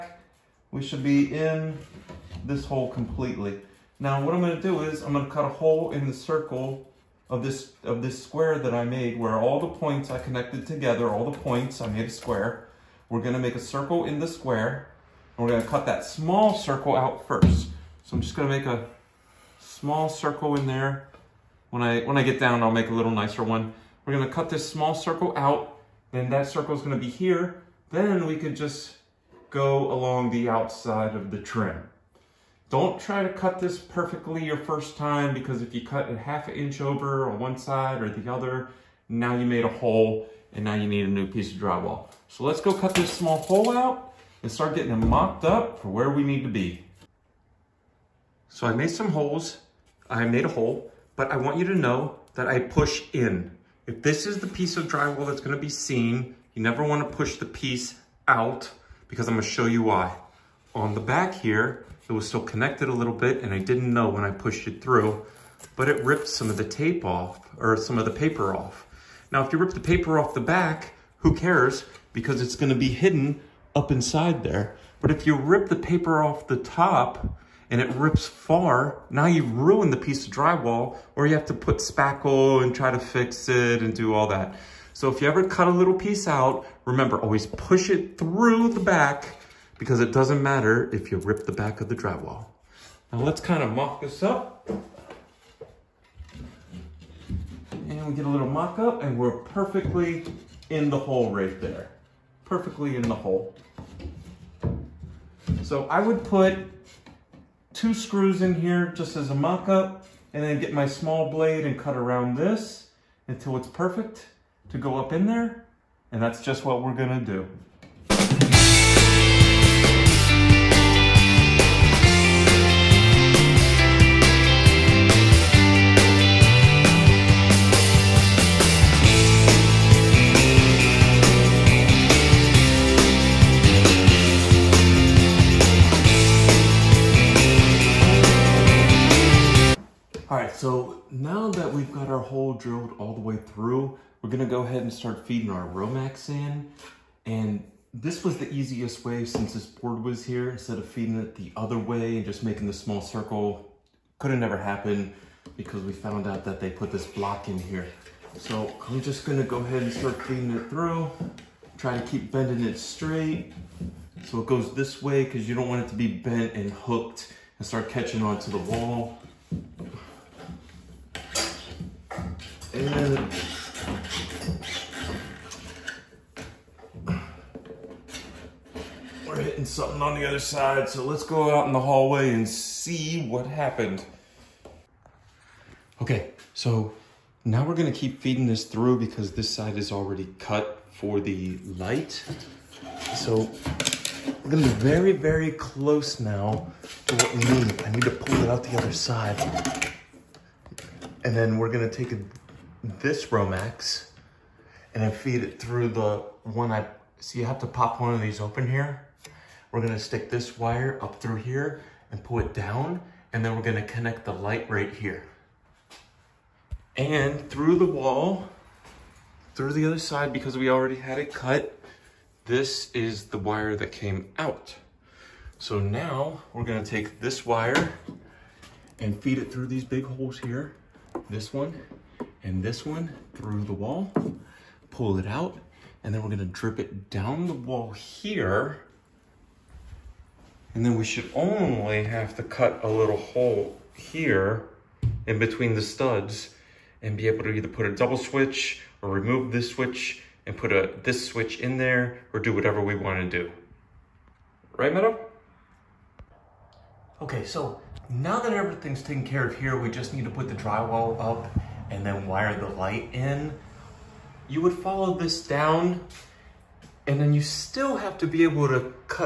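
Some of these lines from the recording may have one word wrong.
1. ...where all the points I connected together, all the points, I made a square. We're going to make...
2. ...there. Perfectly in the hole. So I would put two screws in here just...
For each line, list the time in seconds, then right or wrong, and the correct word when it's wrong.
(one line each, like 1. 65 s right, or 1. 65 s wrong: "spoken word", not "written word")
1. 9 s right
2. 101 s right.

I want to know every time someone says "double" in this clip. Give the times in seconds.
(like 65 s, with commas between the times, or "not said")
247 s.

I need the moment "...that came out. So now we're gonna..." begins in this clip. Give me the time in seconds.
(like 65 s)
223 s.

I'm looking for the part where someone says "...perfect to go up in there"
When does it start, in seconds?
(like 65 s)
113 s.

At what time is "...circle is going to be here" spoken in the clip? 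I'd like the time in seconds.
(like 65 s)
26 s.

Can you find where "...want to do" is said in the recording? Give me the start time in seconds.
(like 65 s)
252 s.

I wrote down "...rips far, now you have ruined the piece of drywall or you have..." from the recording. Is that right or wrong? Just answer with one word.
right.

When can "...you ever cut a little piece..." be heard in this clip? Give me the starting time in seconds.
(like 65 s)
85 s.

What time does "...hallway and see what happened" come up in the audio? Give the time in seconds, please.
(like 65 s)
181 s.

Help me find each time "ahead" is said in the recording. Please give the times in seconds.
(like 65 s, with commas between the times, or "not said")
144 s, 159 s.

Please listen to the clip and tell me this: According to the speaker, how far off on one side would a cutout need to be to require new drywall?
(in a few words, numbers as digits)
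half an inch.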